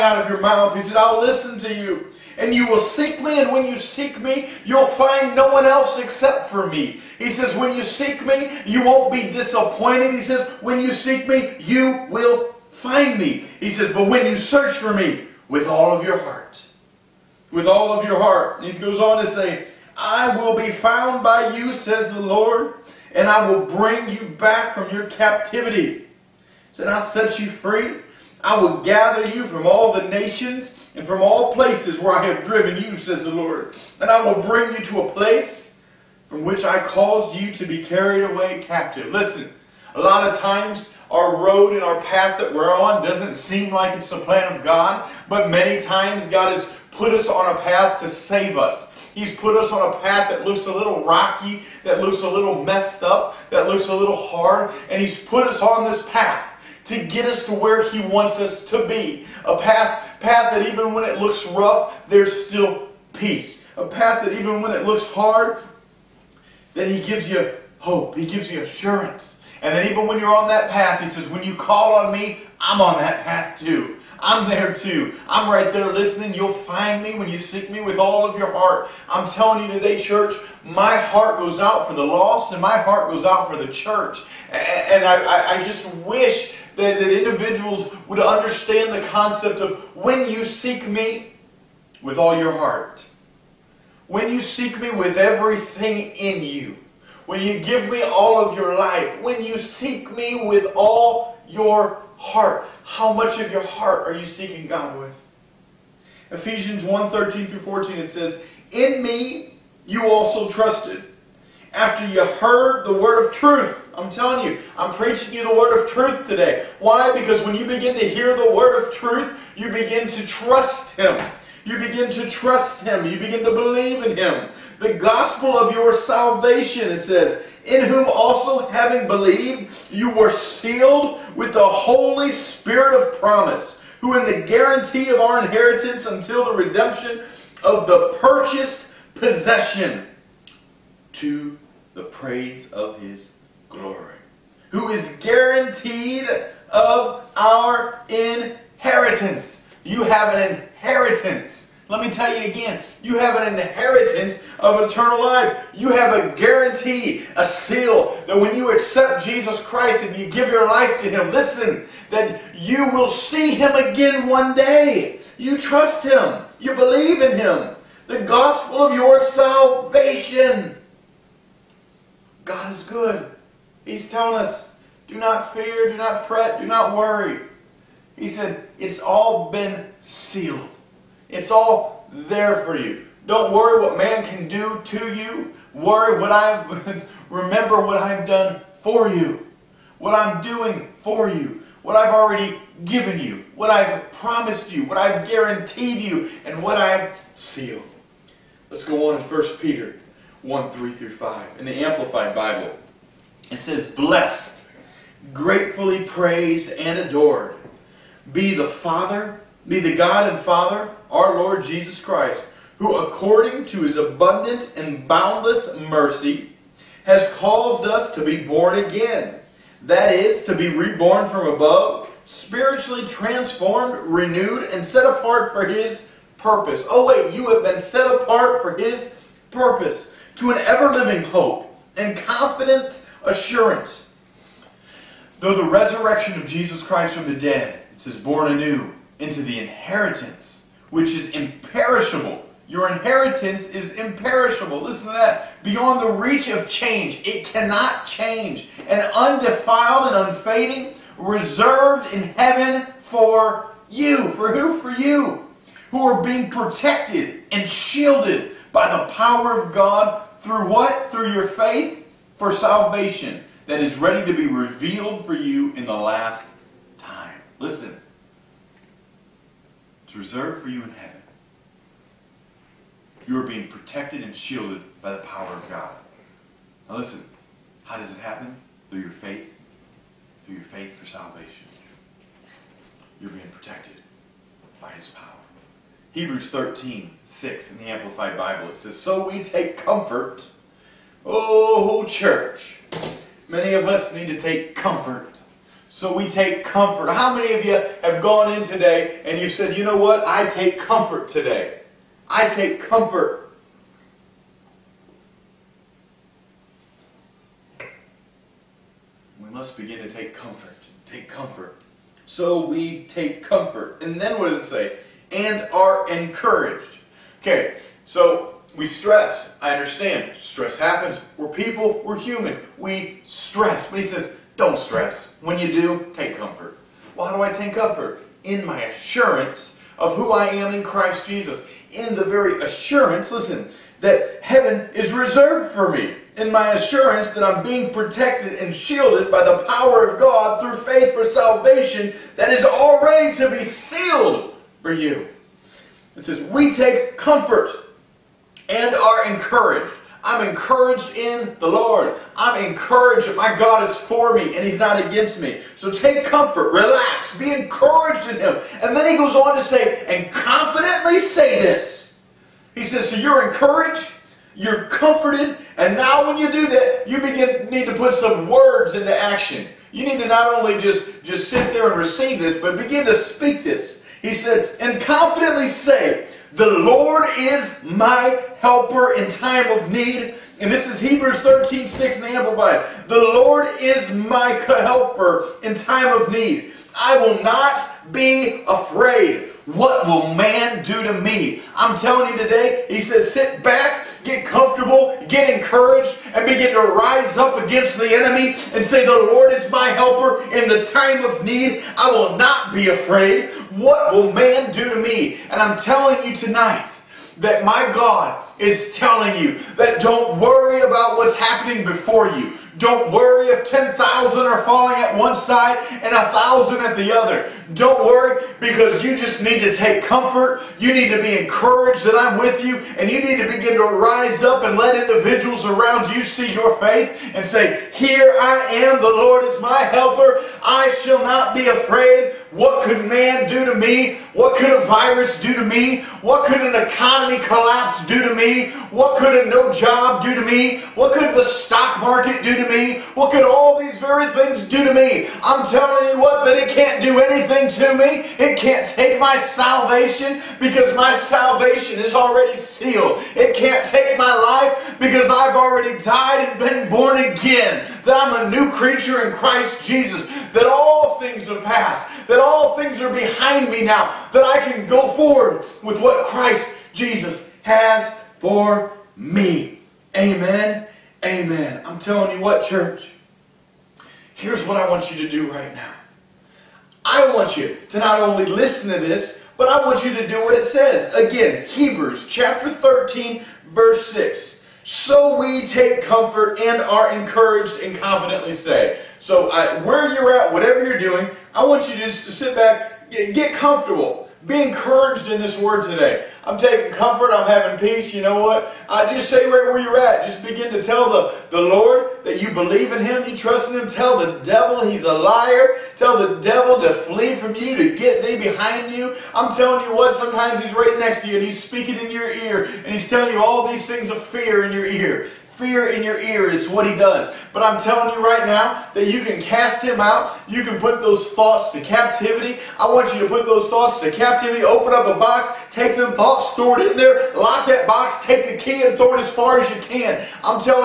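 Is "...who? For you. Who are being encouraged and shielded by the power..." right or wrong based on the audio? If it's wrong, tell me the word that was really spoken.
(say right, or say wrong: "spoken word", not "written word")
wrong: "protected", not "encouraged".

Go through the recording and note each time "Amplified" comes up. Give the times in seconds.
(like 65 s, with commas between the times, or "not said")
201 s, 287 s, 382 s.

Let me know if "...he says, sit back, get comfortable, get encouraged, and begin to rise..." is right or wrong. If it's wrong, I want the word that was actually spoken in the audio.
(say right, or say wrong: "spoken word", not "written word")
right.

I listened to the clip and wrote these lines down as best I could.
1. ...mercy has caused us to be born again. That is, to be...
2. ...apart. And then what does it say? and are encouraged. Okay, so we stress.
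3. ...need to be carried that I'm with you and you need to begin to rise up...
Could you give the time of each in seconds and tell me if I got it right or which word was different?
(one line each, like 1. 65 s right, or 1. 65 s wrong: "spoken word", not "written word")
1. 215 s right
2. 313 s wrong: "comfort", not "apart"
3. 420 s wrong: "encouraged", not "carried".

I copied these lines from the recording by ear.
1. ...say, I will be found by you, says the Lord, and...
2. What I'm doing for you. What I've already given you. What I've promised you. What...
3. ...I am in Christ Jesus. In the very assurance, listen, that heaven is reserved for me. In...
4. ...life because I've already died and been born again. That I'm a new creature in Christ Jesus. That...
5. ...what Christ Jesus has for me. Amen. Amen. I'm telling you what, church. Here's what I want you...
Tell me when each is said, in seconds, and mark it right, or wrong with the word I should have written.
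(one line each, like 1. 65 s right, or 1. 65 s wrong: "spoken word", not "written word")
1. 19 s right
2. 189 s right
3. 330 s right
4. 454 s right
5. 466 s right.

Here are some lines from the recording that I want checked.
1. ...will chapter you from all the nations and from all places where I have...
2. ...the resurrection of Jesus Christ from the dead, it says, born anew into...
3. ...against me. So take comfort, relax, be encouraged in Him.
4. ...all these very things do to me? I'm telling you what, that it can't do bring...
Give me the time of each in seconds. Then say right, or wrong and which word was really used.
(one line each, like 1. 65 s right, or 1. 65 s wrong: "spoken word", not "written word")
1. 28 s wrong: "gather", not "chapter"
2. 235 s right
3. 355 s right
4. 443 s wrong: "anything", not "bring".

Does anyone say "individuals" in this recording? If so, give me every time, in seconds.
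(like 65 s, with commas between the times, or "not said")
87 s, 425 s.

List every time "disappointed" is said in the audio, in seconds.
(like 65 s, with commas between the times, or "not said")
9 s.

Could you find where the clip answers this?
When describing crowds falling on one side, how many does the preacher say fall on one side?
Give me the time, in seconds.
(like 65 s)
413 s.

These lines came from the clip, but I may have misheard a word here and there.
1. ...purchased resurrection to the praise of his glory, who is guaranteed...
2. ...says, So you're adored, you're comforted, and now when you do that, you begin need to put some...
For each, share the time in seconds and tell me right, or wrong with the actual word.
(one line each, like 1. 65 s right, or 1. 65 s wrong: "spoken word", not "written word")
1. 138 s wrong: "possession", not "resurrection"
2. 362 s wrong: "encouraged", not "adored".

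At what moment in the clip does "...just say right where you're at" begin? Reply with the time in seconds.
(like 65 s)
499 s.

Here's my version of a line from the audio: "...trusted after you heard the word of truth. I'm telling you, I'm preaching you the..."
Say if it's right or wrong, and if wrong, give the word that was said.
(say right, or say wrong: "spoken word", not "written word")
right.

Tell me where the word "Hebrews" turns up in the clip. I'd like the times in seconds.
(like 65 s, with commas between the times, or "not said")
286 s, 381 s, 481 s.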